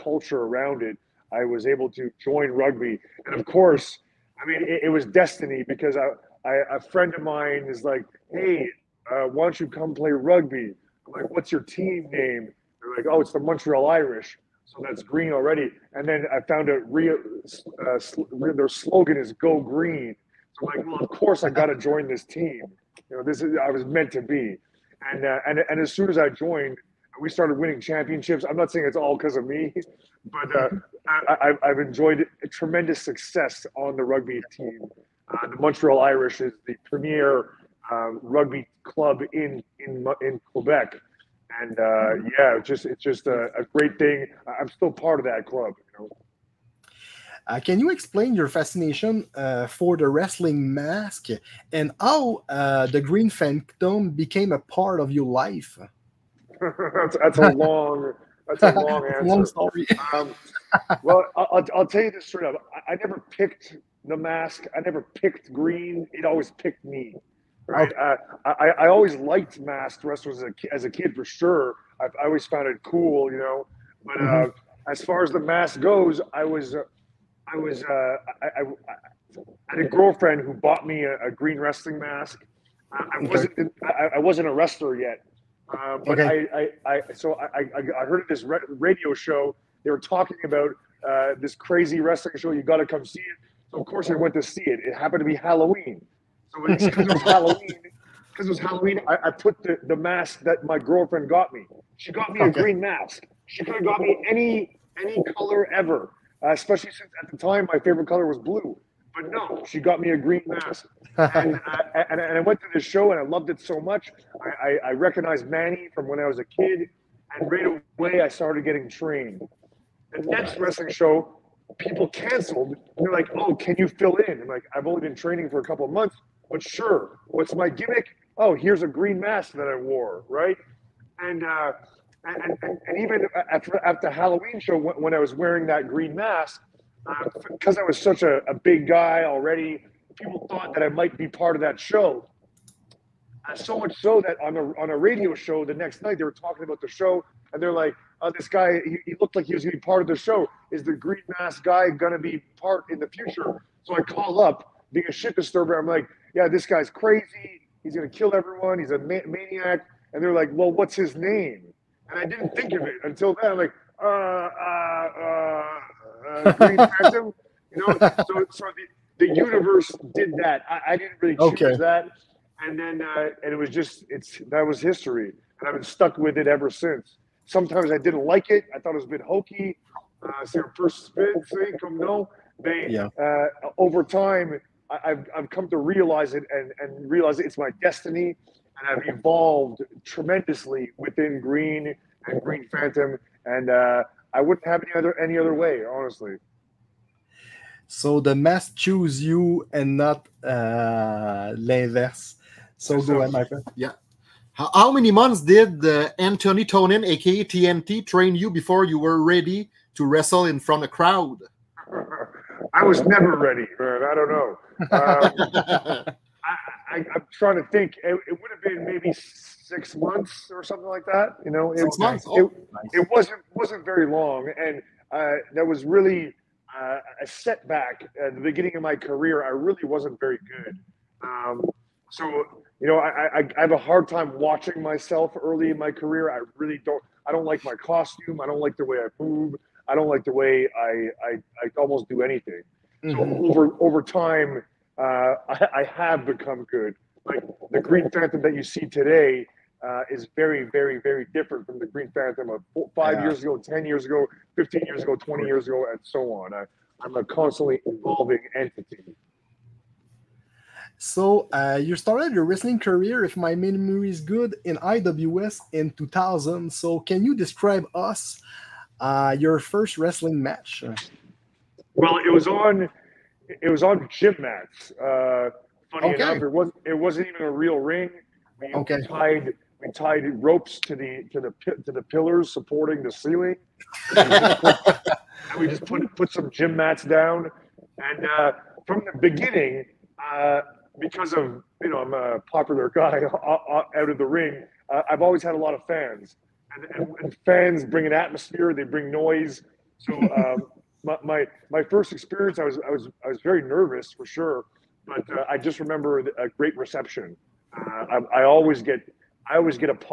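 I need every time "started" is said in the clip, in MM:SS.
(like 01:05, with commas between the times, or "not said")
00:27, 01:58, 04:21.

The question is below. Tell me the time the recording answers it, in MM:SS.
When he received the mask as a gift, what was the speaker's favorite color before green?
01:48.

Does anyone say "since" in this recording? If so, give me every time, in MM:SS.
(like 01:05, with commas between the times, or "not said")
01:46, 02:56.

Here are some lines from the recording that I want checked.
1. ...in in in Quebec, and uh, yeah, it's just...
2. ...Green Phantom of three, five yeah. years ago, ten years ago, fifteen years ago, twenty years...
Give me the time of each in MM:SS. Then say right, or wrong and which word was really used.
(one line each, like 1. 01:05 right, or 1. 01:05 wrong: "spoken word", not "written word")
1. 00:39 right
2. 04:11 wrong: "four", not "three".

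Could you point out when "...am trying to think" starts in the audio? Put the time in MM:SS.
03:36.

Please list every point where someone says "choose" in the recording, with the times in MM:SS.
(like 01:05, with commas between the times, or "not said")
02:51, 03:18.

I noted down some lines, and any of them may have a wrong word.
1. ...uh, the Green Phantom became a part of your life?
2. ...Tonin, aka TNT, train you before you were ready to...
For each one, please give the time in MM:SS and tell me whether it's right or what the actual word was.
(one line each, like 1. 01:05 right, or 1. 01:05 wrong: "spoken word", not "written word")
1. 00:52 right
2. 03:26 right.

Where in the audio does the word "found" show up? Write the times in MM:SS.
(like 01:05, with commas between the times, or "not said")
00:16, 01:12.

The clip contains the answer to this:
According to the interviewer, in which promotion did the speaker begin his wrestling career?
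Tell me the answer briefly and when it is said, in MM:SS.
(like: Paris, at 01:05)
IWS, at 04:24.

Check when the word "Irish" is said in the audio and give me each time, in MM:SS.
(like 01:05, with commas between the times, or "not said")
00:13, 00:35.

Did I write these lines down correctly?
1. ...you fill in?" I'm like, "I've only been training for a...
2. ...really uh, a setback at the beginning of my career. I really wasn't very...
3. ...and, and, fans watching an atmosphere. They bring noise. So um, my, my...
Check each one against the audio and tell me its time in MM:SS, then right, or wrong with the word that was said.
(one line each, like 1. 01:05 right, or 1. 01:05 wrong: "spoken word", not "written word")
1. 02:03 right
2. 03:45 right
3. 04:56 wrong: "bring", not "watching".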